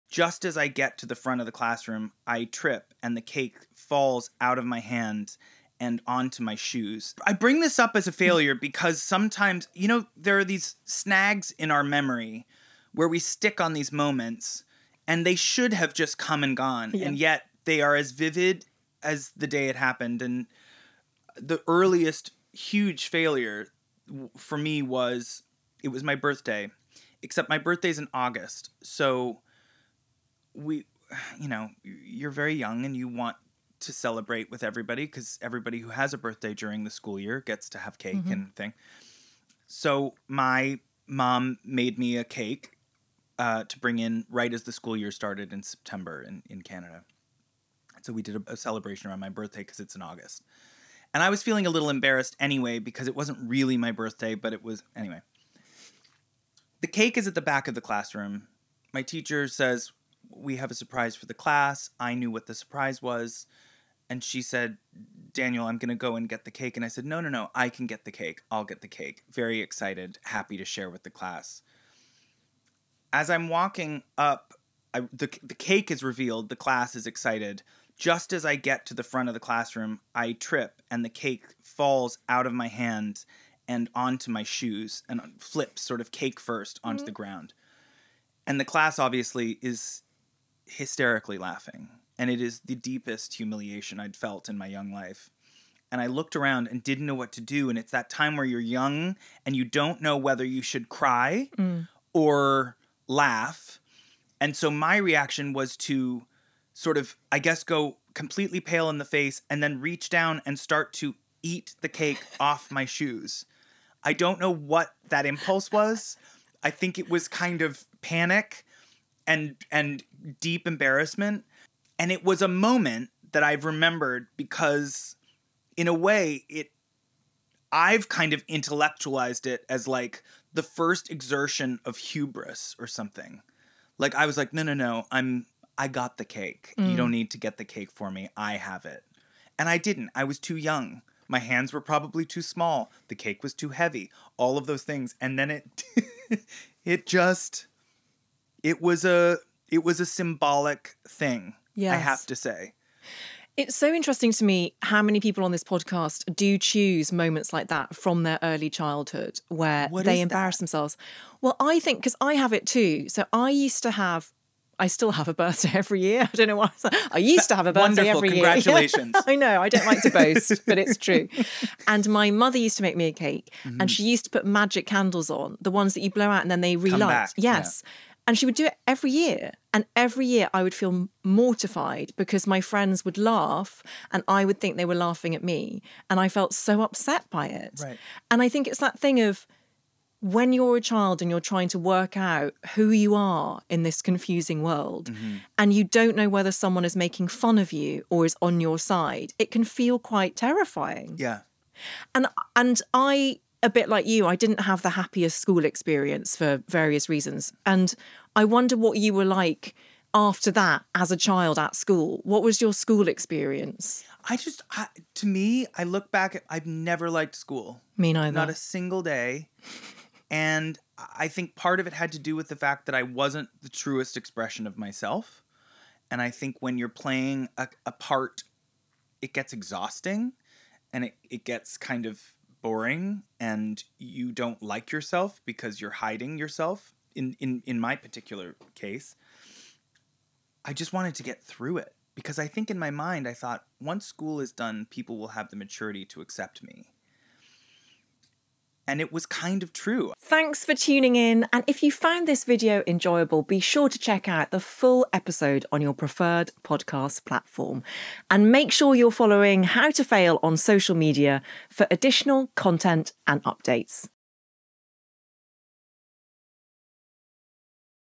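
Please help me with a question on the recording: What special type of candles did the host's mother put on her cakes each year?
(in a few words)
Magic candles.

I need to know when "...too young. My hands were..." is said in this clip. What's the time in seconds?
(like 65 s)
140 s.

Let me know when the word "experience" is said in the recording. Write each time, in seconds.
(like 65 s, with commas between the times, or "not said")
205 s, 213 s.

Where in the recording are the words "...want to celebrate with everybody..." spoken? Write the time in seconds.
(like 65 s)
33 s.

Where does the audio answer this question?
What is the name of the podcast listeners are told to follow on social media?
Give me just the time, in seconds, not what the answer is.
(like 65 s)
259 s.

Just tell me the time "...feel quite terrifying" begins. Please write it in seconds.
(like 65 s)
199 s.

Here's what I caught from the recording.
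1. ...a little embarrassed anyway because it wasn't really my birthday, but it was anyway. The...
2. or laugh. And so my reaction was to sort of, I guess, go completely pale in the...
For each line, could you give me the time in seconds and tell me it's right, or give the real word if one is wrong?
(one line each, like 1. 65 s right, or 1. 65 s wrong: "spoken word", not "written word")
1. 51 s right
2. 102 s right.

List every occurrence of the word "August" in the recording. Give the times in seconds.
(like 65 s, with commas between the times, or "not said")
28 s, 50 s.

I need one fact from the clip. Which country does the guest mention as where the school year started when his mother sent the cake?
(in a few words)
Canada.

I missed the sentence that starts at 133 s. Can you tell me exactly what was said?
Like I was like, no, no, no, I'm I got the cake.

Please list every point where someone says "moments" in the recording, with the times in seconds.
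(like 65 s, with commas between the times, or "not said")
13 s, 122 s, 157 s.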